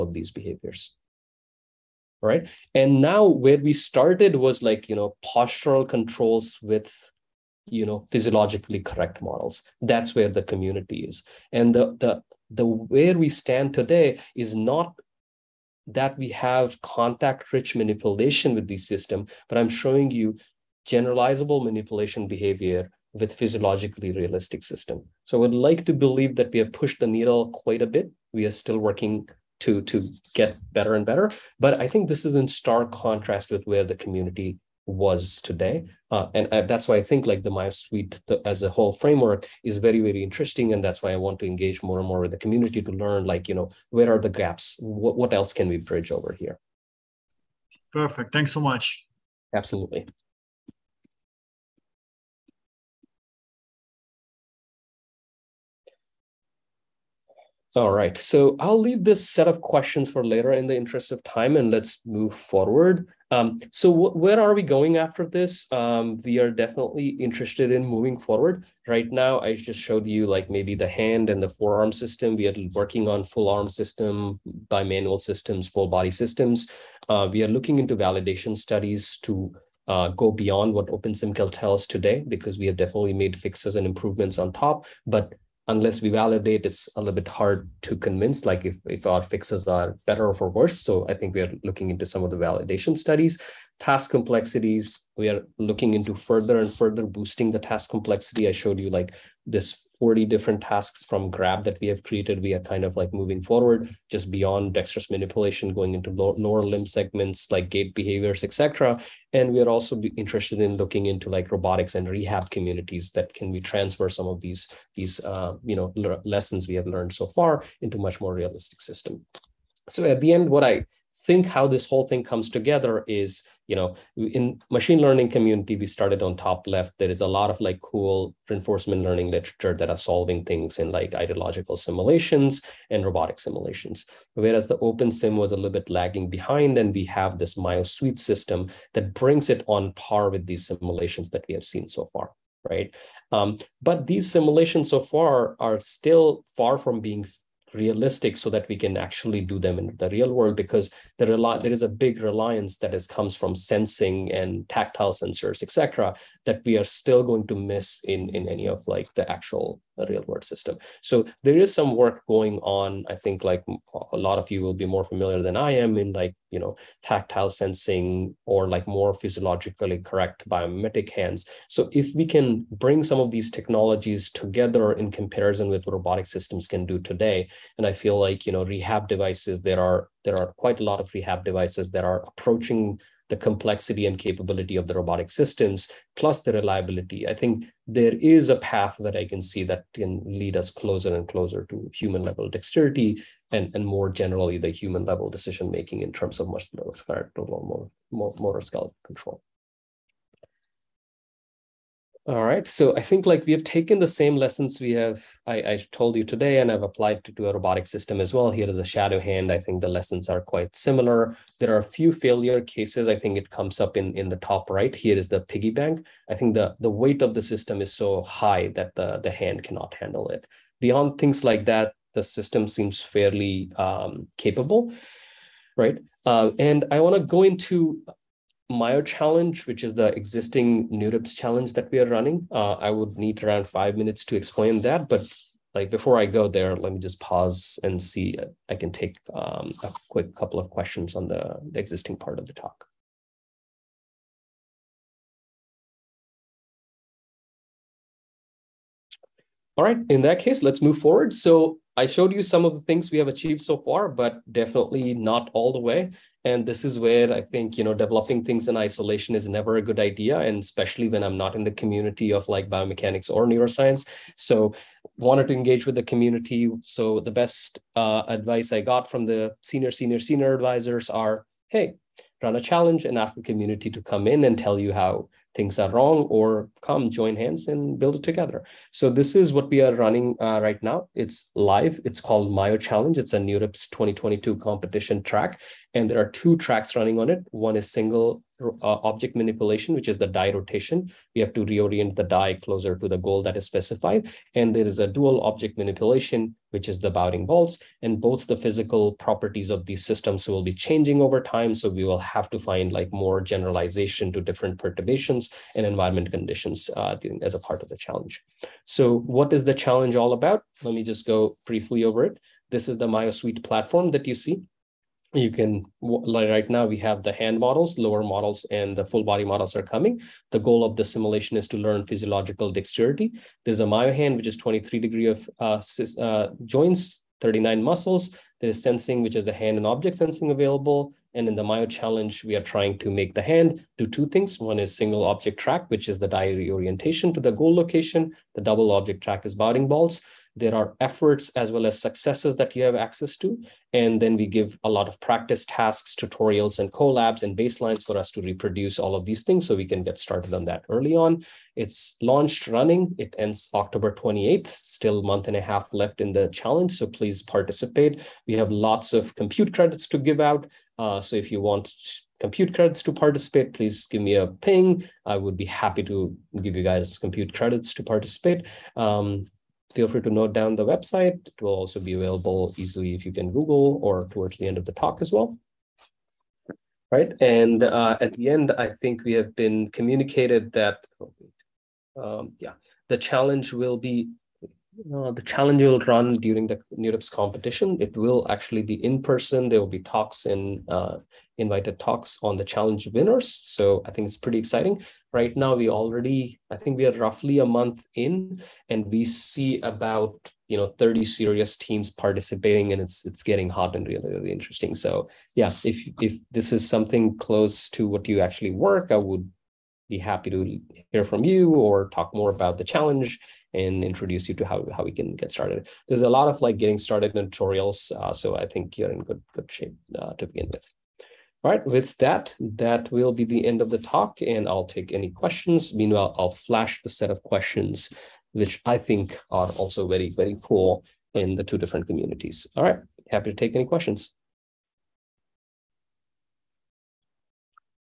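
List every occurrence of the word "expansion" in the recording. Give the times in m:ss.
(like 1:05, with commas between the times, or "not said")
not said.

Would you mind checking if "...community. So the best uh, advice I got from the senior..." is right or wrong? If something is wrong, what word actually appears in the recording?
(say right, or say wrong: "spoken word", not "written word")
right.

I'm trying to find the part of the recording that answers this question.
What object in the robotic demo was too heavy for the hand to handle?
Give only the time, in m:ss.
3:35.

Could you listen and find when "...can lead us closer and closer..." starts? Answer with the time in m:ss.
3:09.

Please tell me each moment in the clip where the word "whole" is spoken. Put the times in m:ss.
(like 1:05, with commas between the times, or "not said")
0:38, 2:01.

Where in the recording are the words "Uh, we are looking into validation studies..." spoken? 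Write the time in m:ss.
1:17.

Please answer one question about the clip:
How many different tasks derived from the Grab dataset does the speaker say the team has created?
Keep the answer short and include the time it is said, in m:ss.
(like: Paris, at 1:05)
40, at 1:40.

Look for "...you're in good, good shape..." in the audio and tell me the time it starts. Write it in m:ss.
6:58.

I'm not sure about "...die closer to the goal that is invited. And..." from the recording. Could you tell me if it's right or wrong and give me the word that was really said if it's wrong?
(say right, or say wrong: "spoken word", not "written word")
wrong: "specified", not "invited".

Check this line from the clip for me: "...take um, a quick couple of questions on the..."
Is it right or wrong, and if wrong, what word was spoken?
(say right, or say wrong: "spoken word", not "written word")
right.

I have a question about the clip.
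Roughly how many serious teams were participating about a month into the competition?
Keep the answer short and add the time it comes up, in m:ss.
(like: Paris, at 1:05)
30, at 6:40.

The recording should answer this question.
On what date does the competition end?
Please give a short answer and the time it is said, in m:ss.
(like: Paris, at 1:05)
October 28th, at 5:53.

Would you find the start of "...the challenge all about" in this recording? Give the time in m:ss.
5:09.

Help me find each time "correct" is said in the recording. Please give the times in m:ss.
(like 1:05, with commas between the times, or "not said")
0:08, 2:49.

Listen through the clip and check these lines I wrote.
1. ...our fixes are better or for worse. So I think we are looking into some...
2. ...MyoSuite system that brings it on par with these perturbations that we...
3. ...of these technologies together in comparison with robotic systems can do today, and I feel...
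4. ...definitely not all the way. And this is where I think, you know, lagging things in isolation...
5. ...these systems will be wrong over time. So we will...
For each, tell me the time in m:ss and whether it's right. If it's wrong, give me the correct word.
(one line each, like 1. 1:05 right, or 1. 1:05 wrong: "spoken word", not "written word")
1. 1:29 right
2. 2:17 wrong: "simulations", not "perturbations"
3. 2:53 right
4. 4:14 wrong: "developing", not "lagging"
5. 4:59 wrong: "changing", not "wrong".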